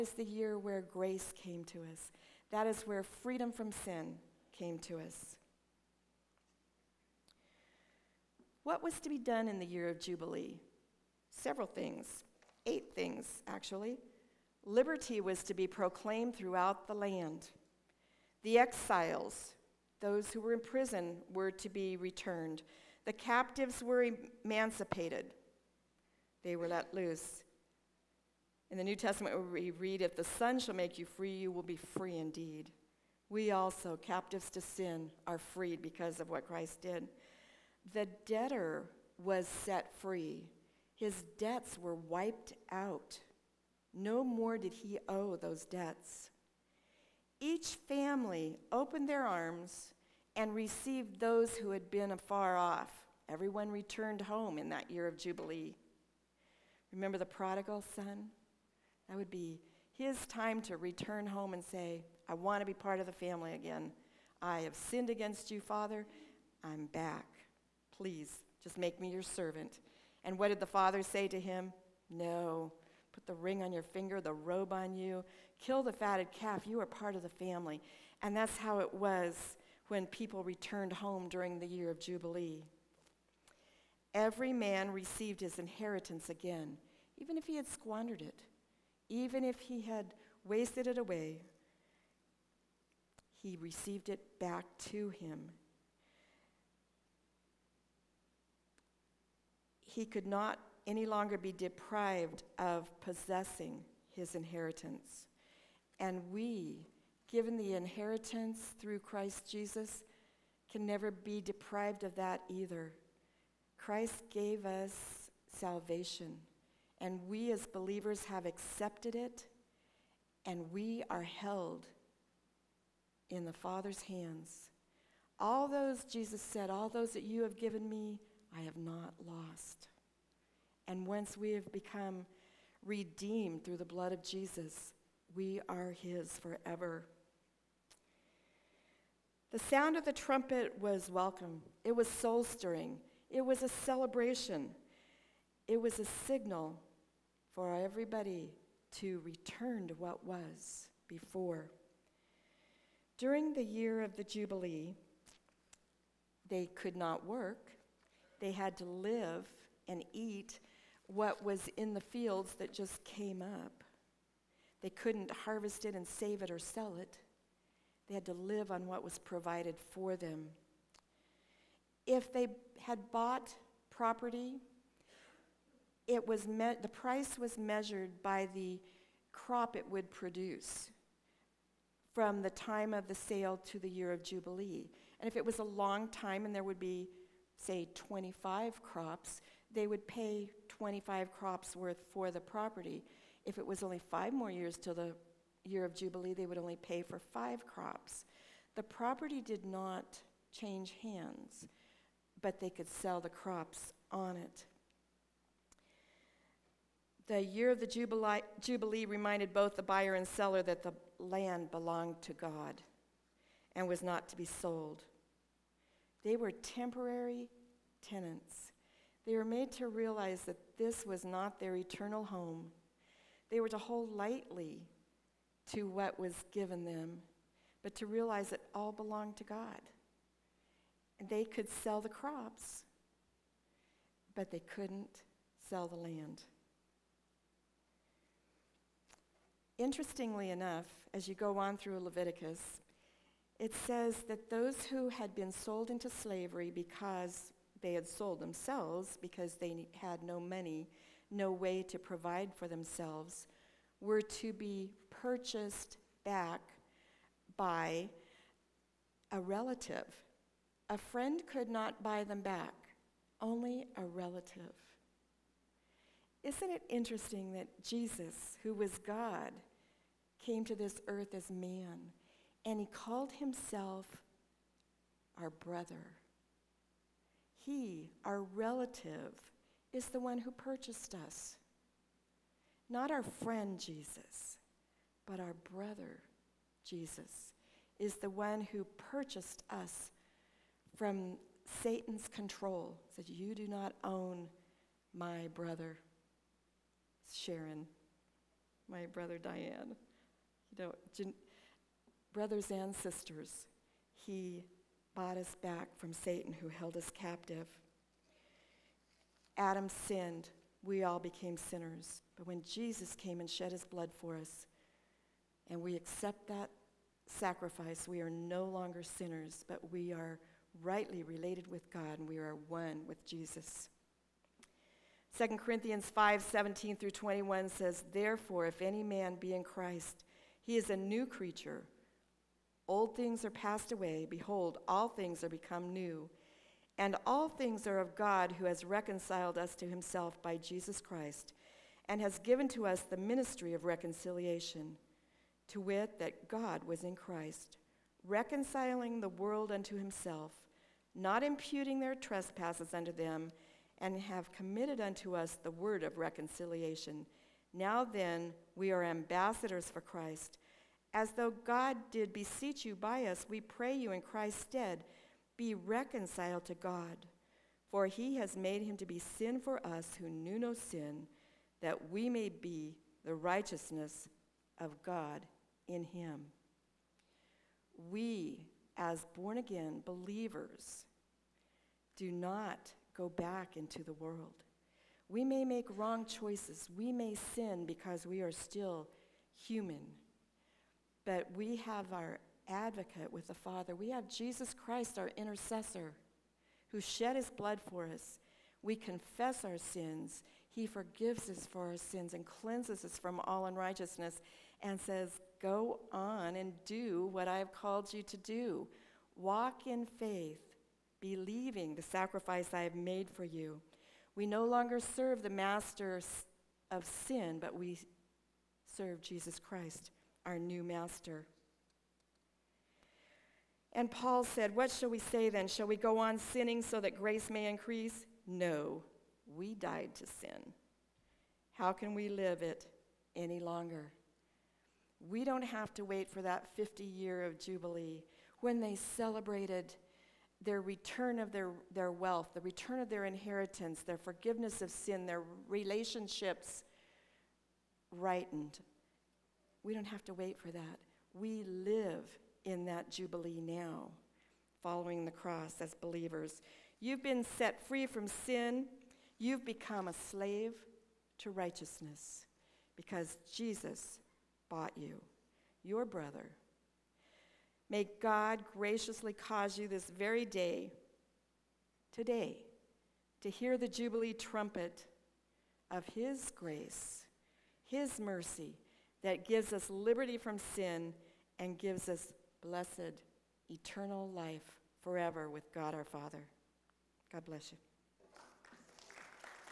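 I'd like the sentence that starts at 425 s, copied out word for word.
Shall we go on sinning so that grace may increase?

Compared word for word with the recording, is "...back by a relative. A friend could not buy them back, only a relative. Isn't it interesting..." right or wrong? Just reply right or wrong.
right.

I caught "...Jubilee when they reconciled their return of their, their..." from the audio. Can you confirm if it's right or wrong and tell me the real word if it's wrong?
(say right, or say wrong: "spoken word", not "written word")
wrong: "celebrated", not "reconciled".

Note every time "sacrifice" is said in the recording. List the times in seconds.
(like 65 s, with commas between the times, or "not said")
317 s, 412 s.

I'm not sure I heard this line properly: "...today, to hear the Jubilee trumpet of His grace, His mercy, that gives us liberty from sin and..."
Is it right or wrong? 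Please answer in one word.
right.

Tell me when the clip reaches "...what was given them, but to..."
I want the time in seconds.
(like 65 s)
225 s.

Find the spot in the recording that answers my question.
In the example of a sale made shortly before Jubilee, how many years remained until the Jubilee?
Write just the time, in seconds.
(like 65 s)
193 s.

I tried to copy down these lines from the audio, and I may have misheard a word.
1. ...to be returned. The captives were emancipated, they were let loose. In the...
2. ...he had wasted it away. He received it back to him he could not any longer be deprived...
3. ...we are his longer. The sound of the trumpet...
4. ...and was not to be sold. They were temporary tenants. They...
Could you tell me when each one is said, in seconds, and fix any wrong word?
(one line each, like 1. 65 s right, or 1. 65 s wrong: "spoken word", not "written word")
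1. 21 s right
2. 89 s right
3. 135 s wrong: "forever", not "longer"
4. 213 s right.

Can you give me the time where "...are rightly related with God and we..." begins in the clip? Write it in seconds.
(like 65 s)
320 s.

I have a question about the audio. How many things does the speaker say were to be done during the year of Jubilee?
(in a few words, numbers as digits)
8.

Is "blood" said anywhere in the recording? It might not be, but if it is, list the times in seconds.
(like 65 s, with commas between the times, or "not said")
133 s, 313 s, 397 s.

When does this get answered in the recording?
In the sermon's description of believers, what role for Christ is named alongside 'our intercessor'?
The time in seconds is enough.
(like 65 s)
392 s.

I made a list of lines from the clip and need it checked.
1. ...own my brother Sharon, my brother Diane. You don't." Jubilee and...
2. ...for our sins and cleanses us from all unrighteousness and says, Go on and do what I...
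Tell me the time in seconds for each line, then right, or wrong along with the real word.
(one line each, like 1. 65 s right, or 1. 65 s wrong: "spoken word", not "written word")
1. 294 s wrong: "Brothers", not "Jubilee"
2. 401 s right.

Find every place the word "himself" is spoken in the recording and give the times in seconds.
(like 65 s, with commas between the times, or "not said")
273 s, 339 s, 349 s.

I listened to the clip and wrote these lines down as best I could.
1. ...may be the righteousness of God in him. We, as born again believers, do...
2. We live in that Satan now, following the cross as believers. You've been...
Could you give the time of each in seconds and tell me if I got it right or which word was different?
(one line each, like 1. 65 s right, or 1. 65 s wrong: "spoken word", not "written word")
1. 372 s right
2. 451 s wrong: "Jubilee", not "Satan".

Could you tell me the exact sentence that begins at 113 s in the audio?
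Christ gave us salvation, and we as believers have accepted it, and we are held in the Father's hands.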